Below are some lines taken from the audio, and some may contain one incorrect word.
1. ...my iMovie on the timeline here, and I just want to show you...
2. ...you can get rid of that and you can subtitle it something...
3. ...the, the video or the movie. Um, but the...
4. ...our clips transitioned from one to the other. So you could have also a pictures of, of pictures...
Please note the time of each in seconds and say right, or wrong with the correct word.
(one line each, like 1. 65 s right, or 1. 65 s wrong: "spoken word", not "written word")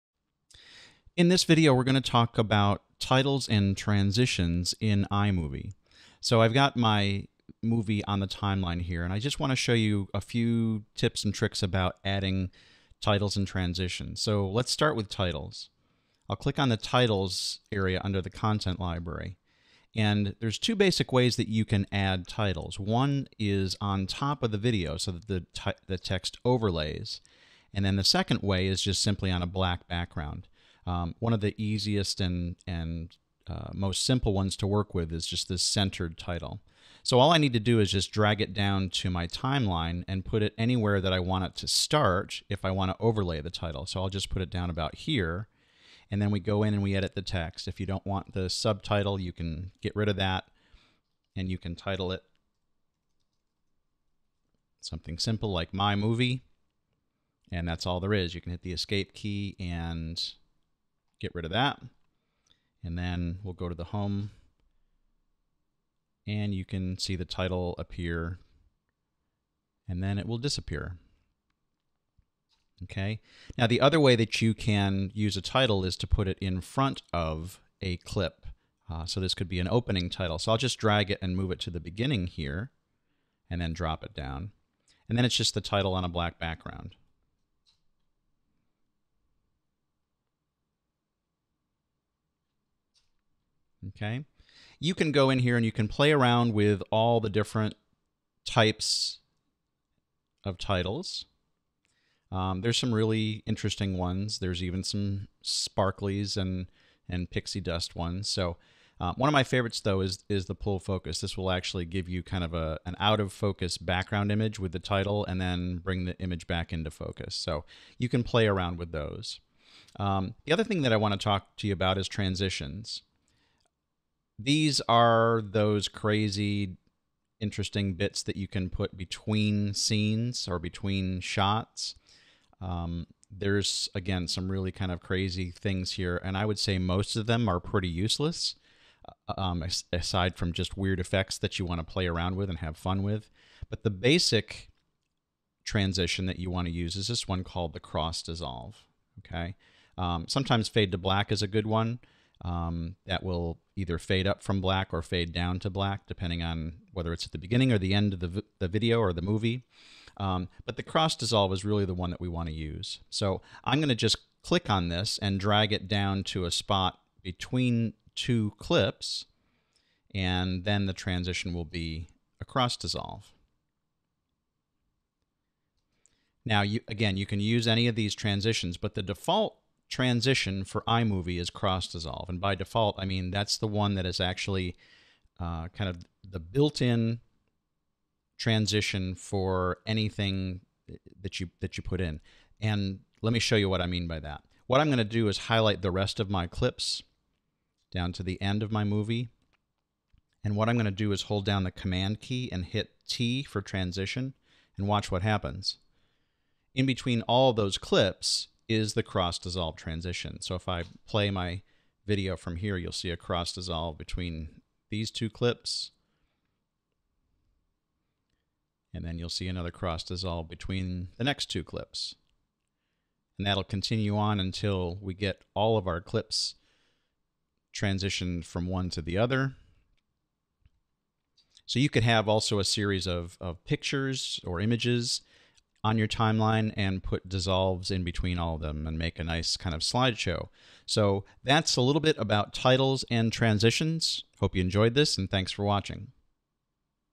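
1. 6 s wrong: "movie", not "iMovie"
2. 49 s wrong: "title", not "subtitle"
3. 158 s right
4. 225 s wrong: "series", not "pictures".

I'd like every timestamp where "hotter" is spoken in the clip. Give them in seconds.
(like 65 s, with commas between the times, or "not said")
not said.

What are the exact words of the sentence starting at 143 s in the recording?
But the basic transition that you want to use is this one called the cross dissolve.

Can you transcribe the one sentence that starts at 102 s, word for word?
Um, there's some really interesting ones.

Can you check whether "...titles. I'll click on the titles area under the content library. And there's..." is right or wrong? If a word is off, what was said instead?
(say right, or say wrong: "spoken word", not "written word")
right.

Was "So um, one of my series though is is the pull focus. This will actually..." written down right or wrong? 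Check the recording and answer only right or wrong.
wrong.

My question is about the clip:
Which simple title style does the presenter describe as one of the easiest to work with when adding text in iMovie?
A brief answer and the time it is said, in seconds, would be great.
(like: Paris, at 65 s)
centered title, at 35 s.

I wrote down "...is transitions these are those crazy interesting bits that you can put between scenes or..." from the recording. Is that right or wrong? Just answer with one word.
right.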